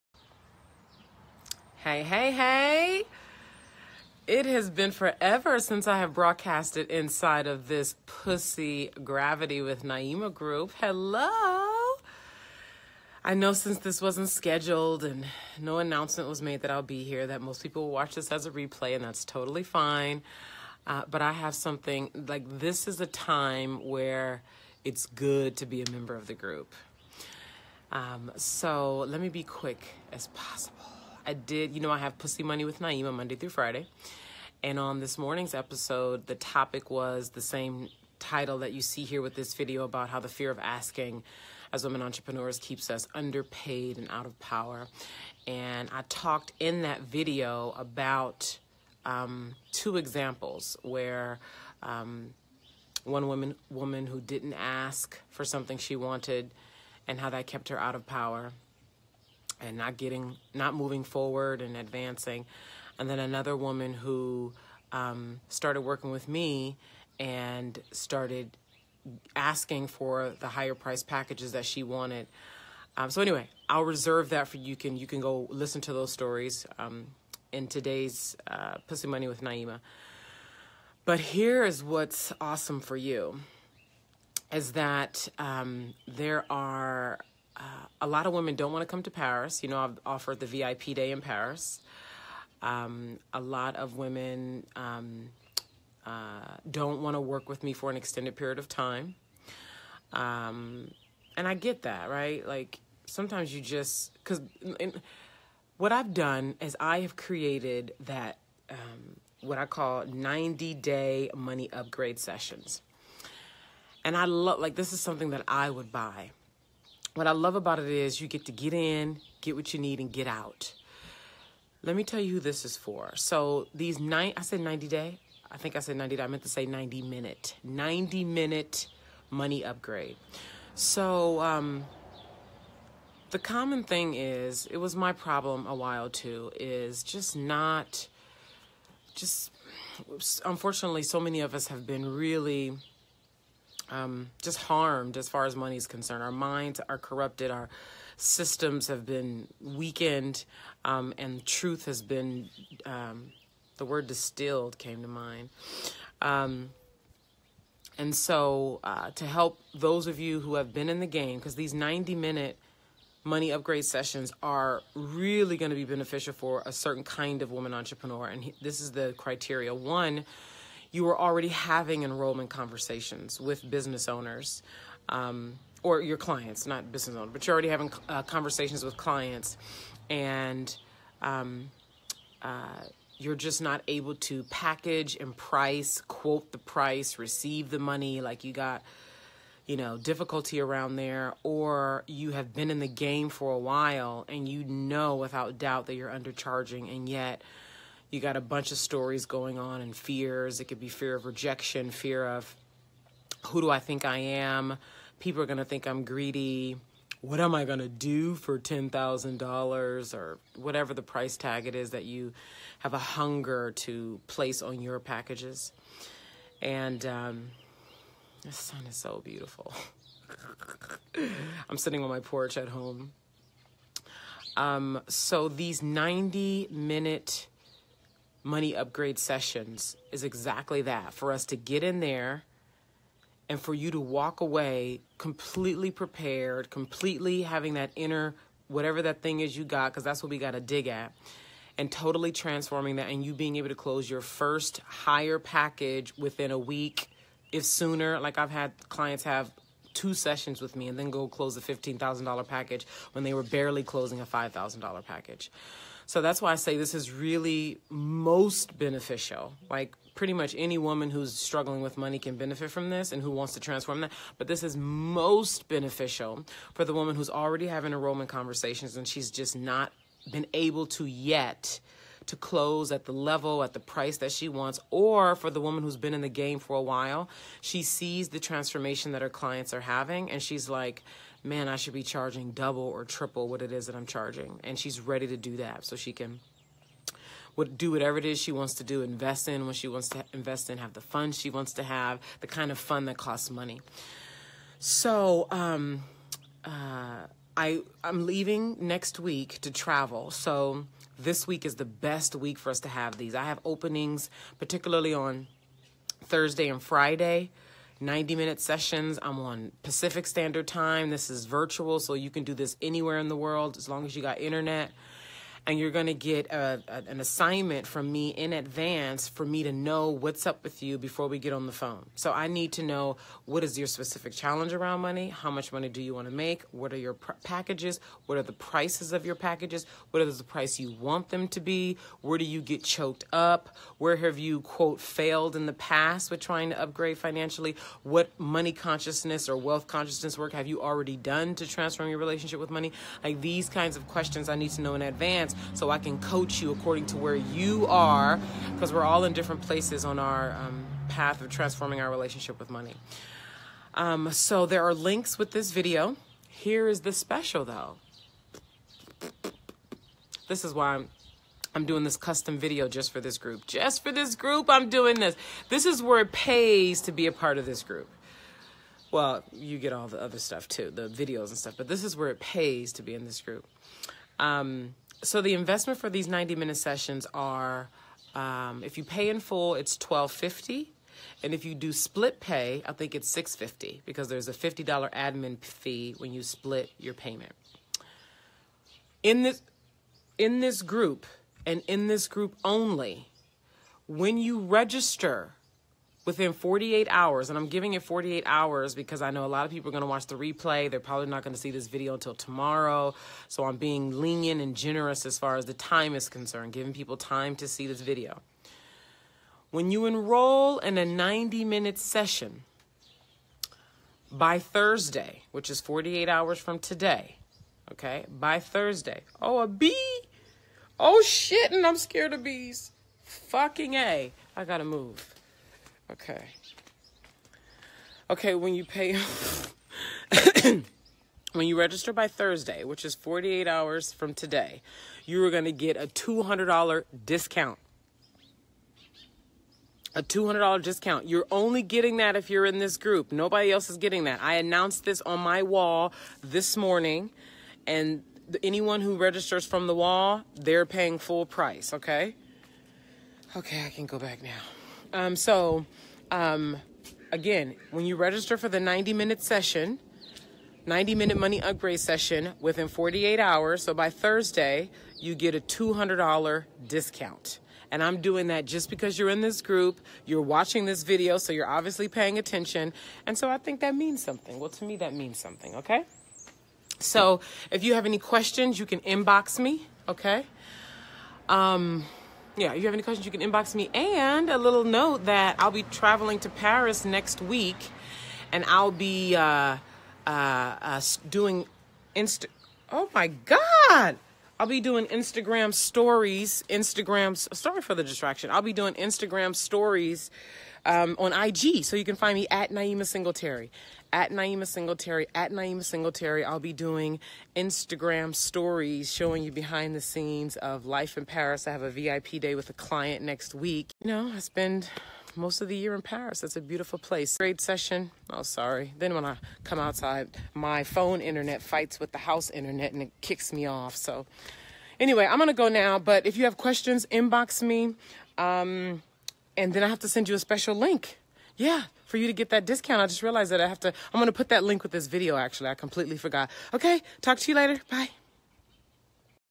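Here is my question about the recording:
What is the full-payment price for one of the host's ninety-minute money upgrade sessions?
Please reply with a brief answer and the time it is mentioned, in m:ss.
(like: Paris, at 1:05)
1250, at 6:19.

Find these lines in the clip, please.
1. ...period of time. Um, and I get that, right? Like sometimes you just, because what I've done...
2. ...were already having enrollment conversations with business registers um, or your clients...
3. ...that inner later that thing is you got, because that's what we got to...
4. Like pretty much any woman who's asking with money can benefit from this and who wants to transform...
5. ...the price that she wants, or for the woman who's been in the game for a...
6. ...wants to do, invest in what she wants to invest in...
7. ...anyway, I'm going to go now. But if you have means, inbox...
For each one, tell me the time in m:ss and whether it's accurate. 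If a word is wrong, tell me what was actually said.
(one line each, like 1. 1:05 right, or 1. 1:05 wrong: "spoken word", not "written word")
1. 1:38 right
2. 2:51 wrong: "owners", not "registers"
3. 3:57 wrong: "whatever", not "later"
4. 4:19 wrong: "struggling", not "asking"
5. 4:33 right
6. 4:48 right
7. 8:44 wrong: "questions", not "means".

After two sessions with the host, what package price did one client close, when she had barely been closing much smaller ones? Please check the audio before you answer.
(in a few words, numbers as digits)
$15,000.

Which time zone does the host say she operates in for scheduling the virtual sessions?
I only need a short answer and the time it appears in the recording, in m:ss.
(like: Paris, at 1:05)
Pacific Standard Time, at 5:09.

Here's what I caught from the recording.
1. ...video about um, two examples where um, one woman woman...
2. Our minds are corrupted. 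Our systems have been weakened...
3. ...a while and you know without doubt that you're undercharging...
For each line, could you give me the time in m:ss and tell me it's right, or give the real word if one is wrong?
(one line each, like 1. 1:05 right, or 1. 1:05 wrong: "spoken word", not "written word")
1. 0:47 right
2. 2:26 right
3. 3:13 right.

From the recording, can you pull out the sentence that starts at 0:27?
Um, so let me be quick as possible.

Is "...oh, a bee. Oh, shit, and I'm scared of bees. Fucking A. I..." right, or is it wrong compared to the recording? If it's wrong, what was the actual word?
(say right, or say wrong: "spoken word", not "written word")
right.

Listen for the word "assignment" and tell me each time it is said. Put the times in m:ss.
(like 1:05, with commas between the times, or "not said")
5:17.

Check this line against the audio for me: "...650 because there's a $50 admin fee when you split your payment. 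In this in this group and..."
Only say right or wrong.
right.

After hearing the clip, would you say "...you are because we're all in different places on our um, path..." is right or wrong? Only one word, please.
right.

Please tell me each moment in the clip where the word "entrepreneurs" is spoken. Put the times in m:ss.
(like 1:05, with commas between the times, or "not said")
0:42, 2:47.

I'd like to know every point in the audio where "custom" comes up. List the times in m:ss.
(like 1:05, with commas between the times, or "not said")
6:02.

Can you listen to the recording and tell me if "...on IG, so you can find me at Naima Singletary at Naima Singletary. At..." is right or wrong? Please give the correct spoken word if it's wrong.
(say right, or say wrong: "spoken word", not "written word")
right.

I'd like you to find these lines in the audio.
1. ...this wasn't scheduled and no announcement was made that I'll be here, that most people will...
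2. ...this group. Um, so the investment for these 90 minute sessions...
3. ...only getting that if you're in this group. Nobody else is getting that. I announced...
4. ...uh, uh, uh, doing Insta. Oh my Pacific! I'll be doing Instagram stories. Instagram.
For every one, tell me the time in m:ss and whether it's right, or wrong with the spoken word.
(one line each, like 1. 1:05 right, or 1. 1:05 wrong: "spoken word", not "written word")
1. 0:13 right
2. 6:13 right
3. 7:21 right
4. 8:09 wrong: "God", not "Pacific".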